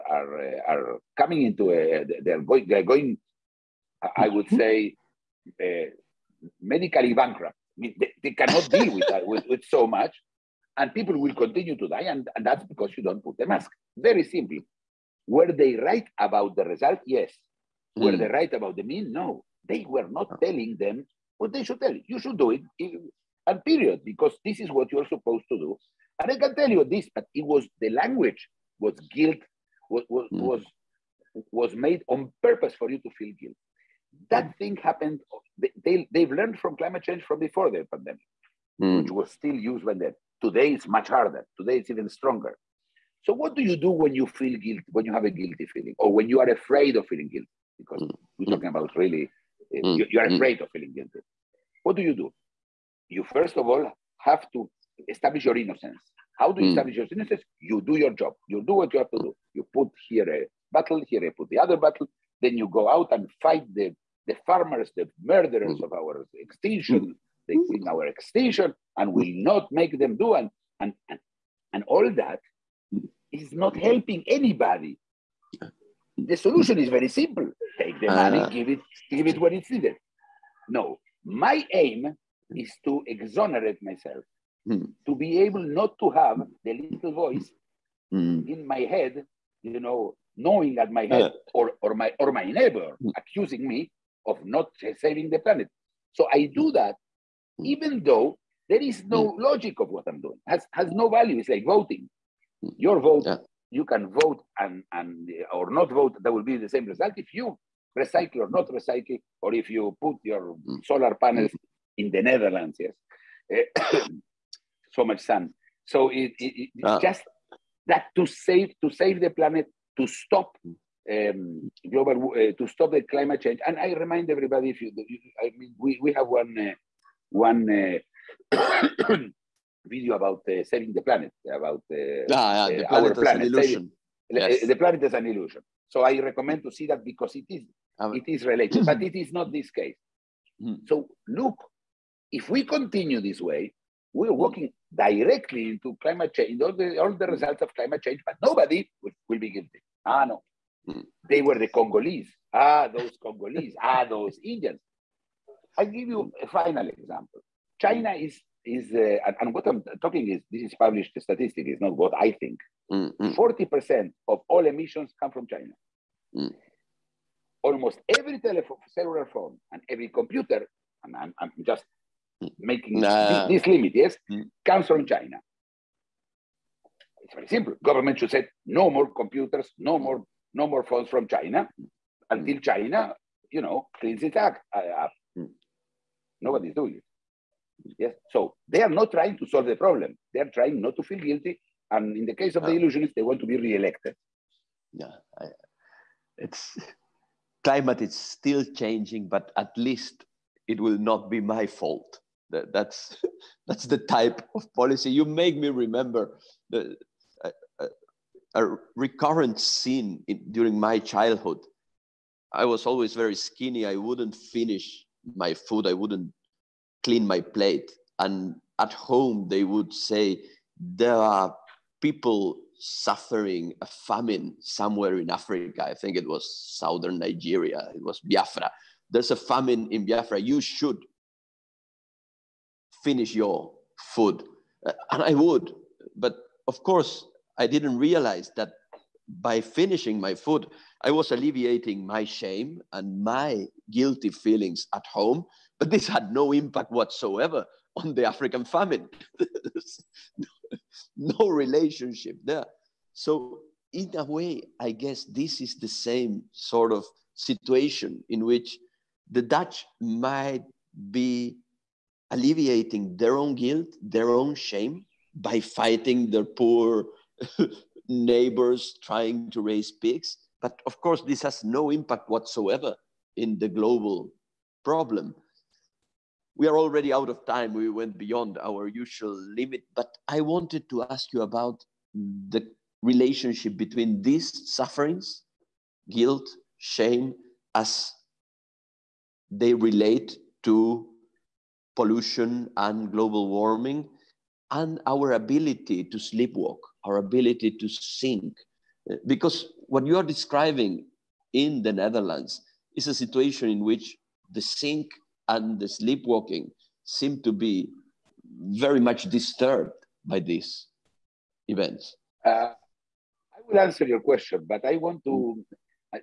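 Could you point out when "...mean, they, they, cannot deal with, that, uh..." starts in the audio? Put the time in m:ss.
0:07.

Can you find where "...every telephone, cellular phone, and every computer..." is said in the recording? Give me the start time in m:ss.
2:48.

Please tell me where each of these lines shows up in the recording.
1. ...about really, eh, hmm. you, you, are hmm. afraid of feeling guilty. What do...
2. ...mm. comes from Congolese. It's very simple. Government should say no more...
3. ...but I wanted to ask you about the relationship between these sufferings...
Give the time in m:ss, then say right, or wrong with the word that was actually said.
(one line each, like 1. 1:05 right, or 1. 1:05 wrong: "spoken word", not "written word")
1. 0:48 right
2. 2:54 wrong: "China", not "Congolese"
3. 4:39 right.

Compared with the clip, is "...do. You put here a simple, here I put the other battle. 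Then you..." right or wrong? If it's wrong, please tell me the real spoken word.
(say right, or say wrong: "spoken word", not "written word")
wrong: "battle", not "simple".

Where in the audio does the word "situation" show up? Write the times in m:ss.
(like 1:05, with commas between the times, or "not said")
4:17, 5:03.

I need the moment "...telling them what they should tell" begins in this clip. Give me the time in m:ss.
0:20.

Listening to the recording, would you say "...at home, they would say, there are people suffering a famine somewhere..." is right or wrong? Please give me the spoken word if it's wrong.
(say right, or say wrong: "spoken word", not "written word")
right.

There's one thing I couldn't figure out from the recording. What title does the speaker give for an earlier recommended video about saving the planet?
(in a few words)
The planet is an illusion.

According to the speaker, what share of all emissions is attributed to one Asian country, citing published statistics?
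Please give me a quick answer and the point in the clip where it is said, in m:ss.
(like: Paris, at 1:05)
40 percent, at 2:43.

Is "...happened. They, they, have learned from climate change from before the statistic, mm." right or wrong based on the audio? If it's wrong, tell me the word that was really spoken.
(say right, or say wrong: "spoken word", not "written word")
wrong: "pandemic", not "statistic".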